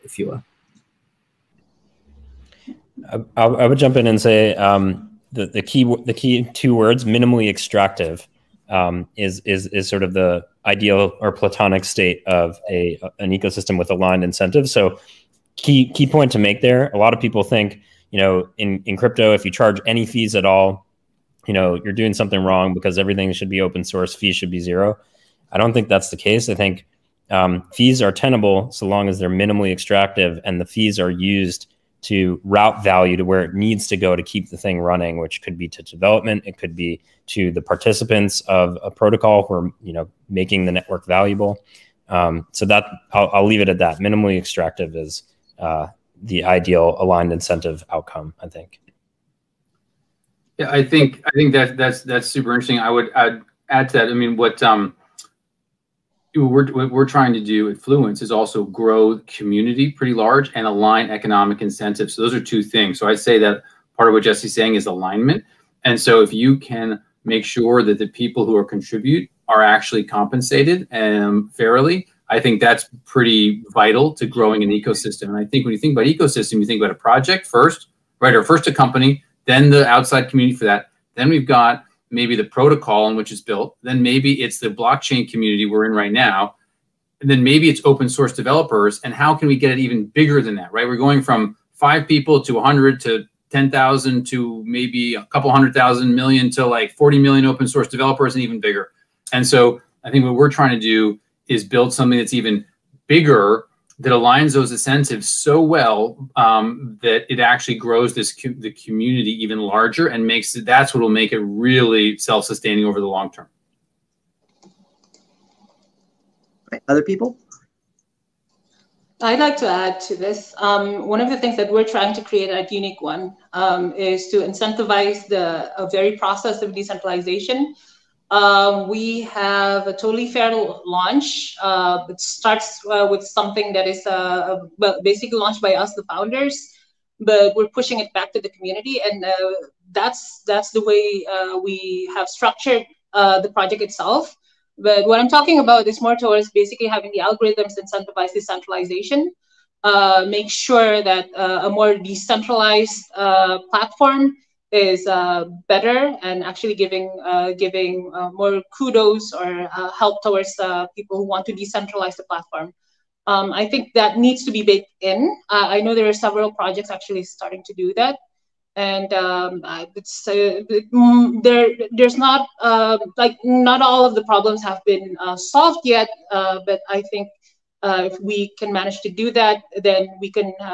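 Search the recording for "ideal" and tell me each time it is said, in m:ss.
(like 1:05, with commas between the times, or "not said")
0:10, 0:46.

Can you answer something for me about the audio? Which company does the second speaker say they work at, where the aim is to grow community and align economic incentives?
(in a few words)
Fluence.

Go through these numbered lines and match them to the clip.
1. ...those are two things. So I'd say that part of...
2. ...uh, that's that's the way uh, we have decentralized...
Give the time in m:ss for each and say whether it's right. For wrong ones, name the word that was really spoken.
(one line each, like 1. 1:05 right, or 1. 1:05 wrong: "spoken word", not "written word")
1. 1:02 right
2. 2:19 wrong: "structured", not "decentralized".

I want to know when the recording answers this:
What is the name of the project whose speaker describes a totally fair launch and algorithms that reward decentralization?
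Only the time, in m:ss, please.
2:02.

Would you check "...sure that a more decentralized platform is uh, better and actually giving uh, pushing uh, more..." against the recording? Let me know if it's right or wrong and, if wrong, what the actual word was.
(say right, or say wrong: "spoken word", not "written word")
wrong: "giving", not "pushing".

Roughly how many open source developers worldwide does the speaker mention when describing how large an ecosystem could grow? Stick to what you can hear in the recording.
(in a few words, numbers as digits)
40 million.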